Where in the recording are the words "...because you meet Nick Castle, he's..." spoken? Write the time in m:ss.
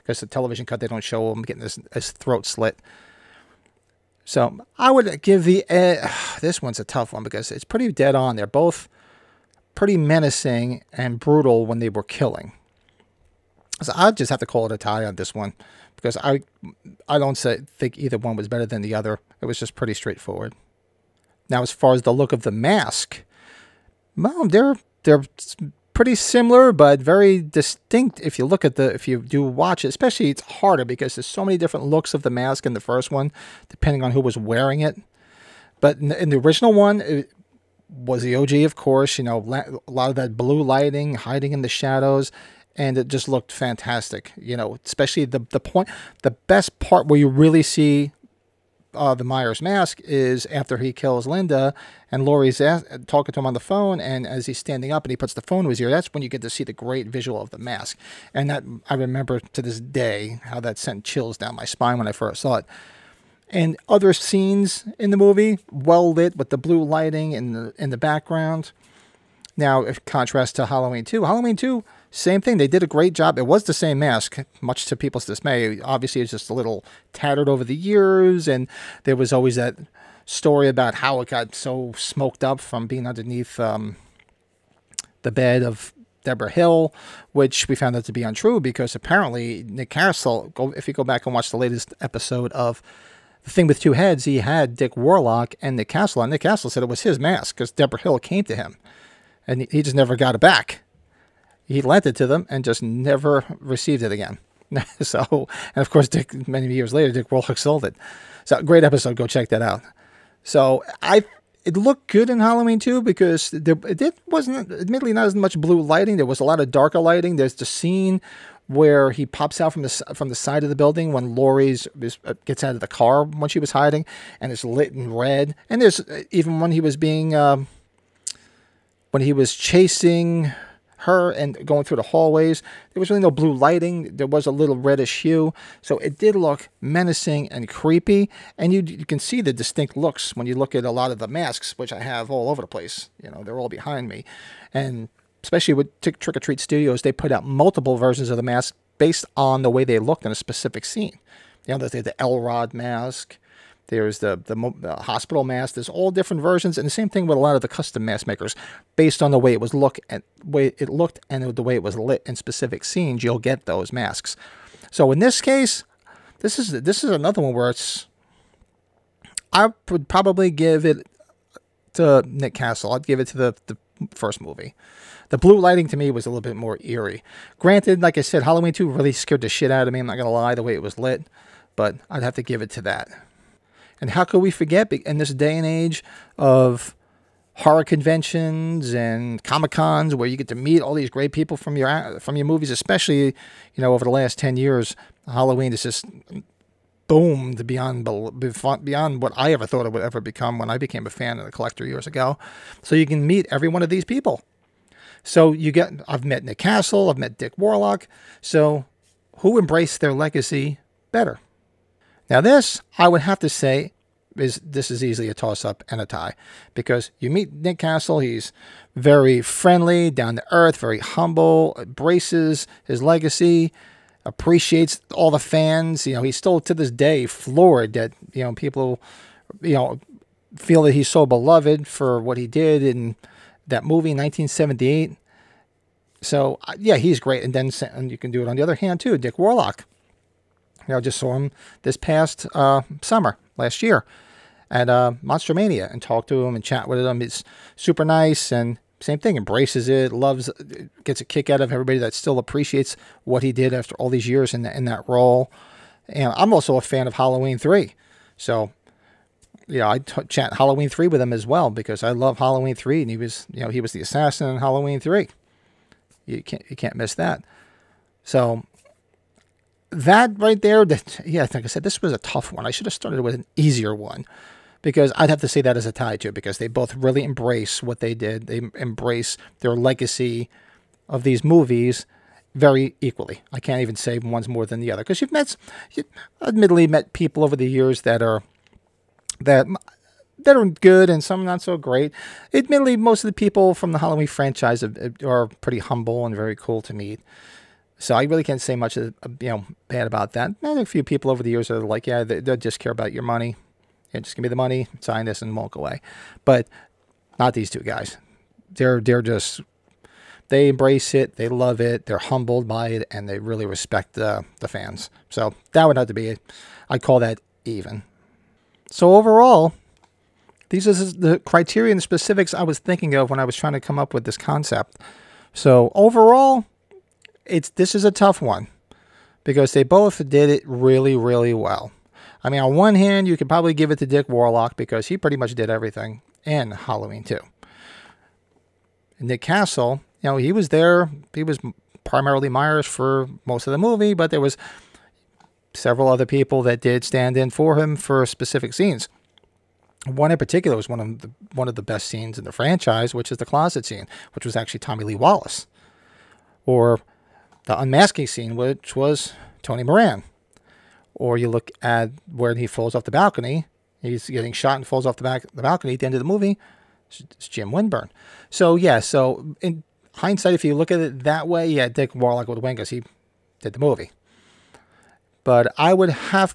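3:36.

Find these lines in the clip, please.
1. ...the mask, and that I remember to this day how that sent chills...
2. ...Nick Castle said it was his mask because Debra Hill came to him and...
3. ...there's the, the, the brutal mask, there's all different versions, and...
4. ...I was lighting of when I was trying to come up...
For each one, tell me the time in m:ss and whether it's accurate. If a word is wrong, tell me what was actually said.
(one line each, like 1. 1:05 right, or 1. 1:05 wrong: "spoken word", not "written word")
1. 0:57 right
2. 1:36 right
3. 2:33 wrong: "hospital", not "brutal"
4. 5:22 wrong: "thinking", not "lighting".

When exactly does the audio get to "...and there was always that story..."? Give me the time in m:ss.
1:18.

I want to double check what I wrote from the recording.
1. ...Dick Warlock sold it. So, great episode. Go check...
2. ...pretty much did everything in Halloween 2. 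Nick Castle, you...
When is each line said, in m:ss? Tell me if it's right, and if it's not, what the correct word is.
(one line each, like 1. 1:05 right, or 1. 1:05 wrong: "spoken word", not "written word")
1. 1:47 right
2. 5:35 right.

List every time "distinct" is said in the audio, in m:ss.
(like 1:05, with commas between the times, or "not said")
0:27, 2:19.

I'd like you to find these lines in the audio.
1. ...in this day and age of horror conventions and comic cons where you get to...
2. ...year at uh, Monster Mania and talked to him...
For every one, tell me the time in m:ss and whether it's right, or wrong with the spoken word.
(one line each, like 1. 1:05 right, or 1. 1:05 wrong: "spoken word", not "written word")
1. 3:04 right
2. 4:03 right.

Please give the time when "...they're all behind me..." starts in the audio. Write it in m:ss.
2:23.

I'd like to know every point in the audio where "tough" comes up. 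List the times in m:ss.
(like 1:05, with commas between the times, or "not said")
0:06, 4:32, 5:28.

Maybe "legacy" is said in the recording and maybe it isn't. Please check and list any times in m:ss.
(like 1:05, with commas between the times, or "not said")
3:30, 3:43, 4:39.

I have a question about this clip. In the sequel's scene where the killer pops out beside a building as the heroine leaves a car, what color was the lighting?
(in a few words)
Red.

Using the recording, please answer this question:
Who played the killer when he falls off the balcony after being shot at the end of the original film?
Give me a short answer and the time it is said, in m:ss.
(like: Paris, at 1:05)
Jim Winburn, at 6:07.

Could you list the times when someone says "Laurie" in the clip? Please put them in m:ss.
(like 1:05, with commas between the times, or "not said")
0:52, 2:01.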